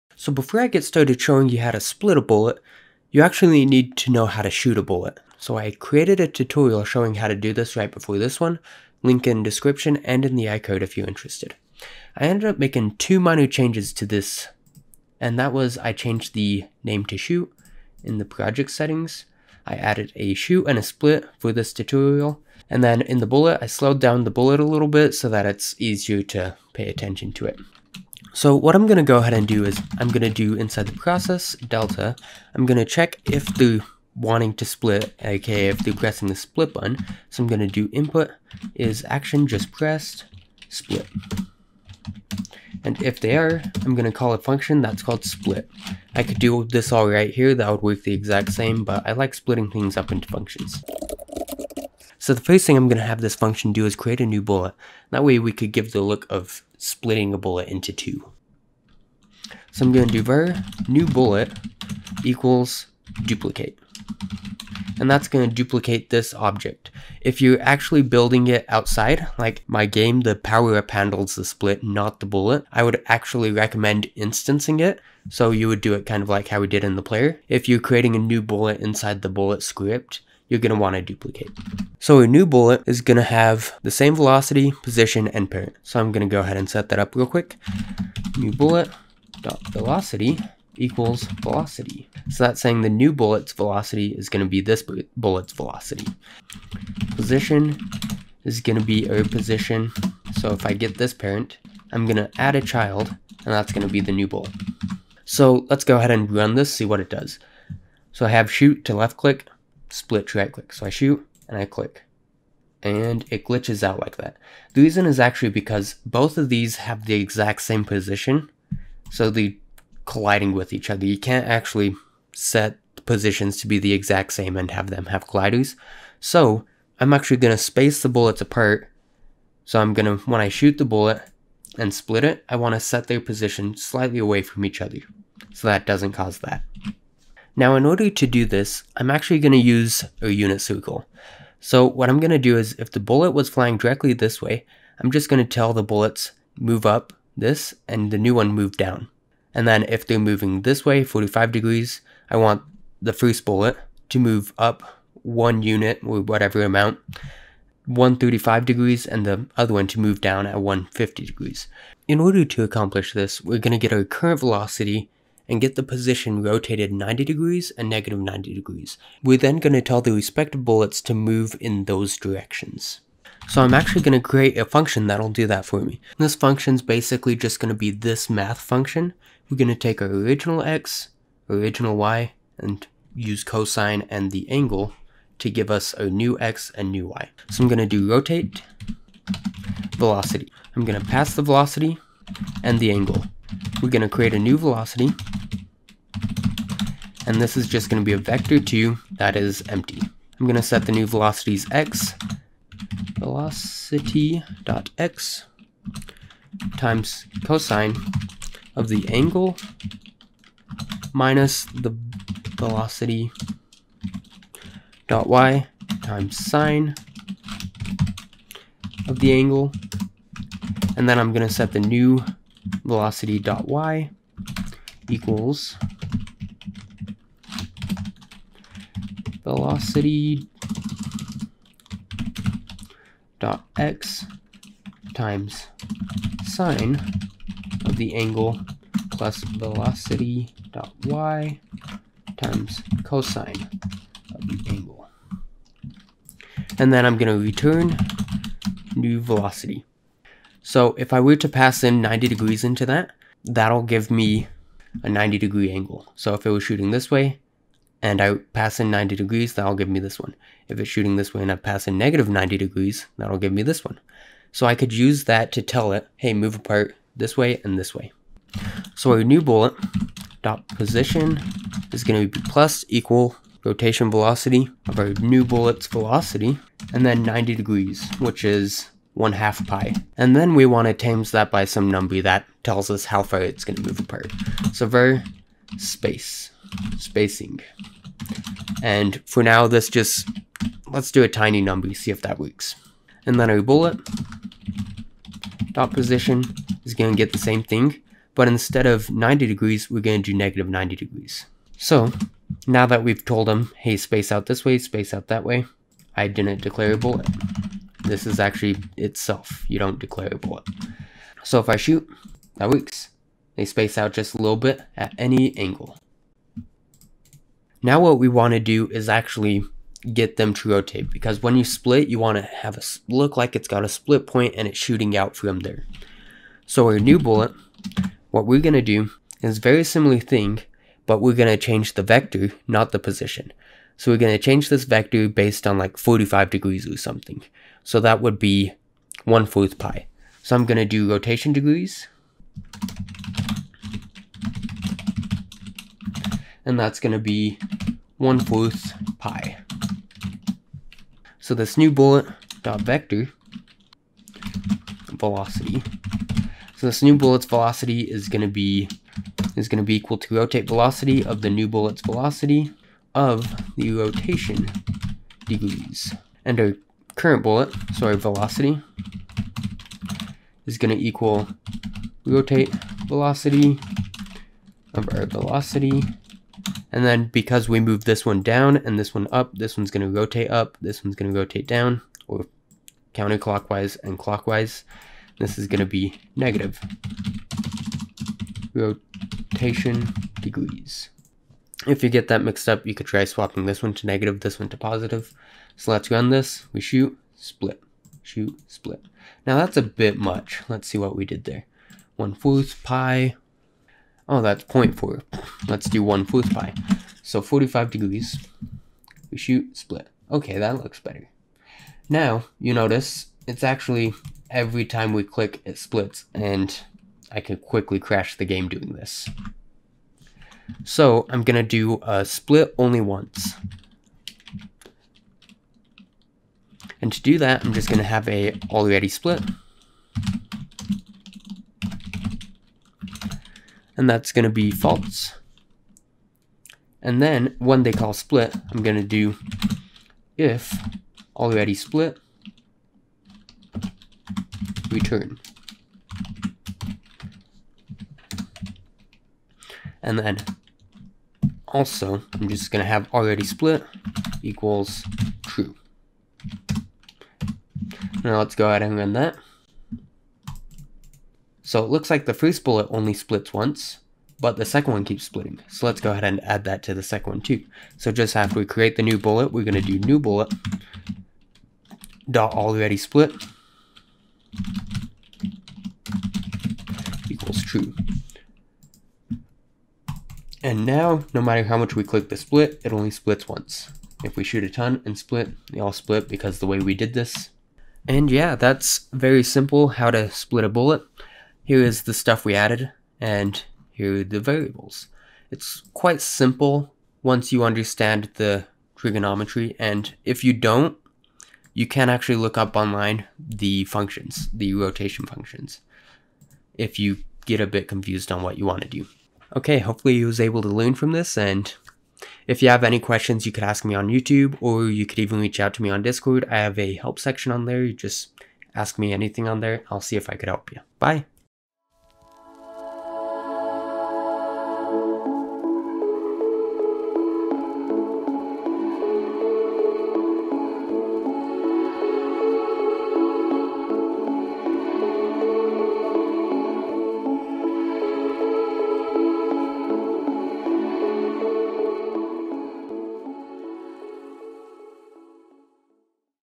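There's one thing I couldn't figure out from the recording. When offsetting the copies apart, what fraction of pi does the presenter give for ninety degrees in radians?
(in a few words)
1 half pi.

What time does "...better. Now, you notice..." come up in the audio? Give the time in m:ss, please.
6:51.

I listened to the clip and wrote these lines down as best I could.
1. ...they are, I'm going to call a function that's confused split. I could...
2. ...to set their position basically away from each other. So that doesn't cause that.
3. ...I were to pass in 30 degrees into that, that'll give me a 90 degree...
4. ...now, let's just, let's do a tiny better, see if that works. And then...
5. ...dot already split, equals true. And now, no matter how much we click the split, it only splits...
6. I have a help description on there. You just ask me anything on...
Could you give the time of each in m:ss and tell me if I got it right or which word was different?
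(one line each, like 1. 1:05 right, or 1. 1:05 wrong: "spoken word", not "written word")
1. 0:43 wrong: "called", not "confused"
2. 2:12 wrong: "slightly", not "basically"
3. 4:11 wrong: "90", not "30"
4. 4:49 wrong: "number", not "better"
5. 7:52 right
6. 8:36 wrong: "section", not "description".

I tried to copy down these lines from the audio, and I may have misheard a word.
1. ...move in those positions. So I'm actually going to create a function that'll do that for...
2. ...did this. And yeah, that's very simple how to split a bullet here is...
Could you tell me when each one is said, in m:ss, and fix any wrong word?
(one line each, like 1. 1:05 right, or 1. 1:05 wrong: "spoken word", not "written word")
1. 2:51 wrong: "directions", not "positions"
2. 8:06 right.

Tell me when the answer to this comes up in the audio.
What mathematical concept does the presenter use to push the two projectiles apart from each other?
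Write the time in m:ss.
2:20.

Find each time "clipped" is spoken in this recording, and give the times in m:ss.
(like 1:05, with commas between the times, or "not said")
not said.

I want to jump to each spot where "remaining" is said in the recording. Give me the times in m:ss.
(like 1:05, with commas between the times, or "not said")
not said.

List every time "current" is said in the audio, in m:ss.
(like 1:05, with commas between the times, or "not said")
2:44, 6:07.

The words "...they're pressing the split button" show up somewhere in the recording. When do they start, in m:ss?
0:35.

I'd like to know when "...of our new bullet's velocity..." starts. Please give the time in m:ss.
4:34.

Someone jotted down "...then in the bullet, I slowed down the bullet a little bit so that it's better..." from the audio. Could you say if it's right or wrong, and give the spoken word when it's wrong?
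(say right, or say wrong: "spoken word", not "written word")
wrong: "easier", not "better".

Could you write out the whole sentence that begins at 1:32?
So that's saying the new bullet's velocity is going to be this bullet's velocity.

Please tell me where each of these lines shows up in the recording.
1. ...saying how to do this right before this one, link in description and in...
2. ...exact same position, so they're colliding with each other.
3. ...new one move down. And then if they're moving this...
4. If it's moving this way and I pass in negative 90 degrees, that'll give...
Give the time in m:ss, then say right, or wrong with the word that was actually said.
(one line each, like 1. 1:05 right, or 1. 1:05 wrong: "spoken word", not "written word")
1. 0:06 wrong: "showing", not "saying"
2. 1:57 right
3. 2:28 right
4. 4:20 wrong: "shooting", not "moving".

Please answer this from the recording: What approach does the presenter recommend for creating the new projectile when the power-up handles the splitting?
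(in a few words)
instancing.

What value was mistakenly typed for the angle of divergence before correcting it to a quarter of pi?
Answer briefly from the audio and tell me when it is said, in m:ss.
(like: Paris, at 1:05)
0.4, at 6:44.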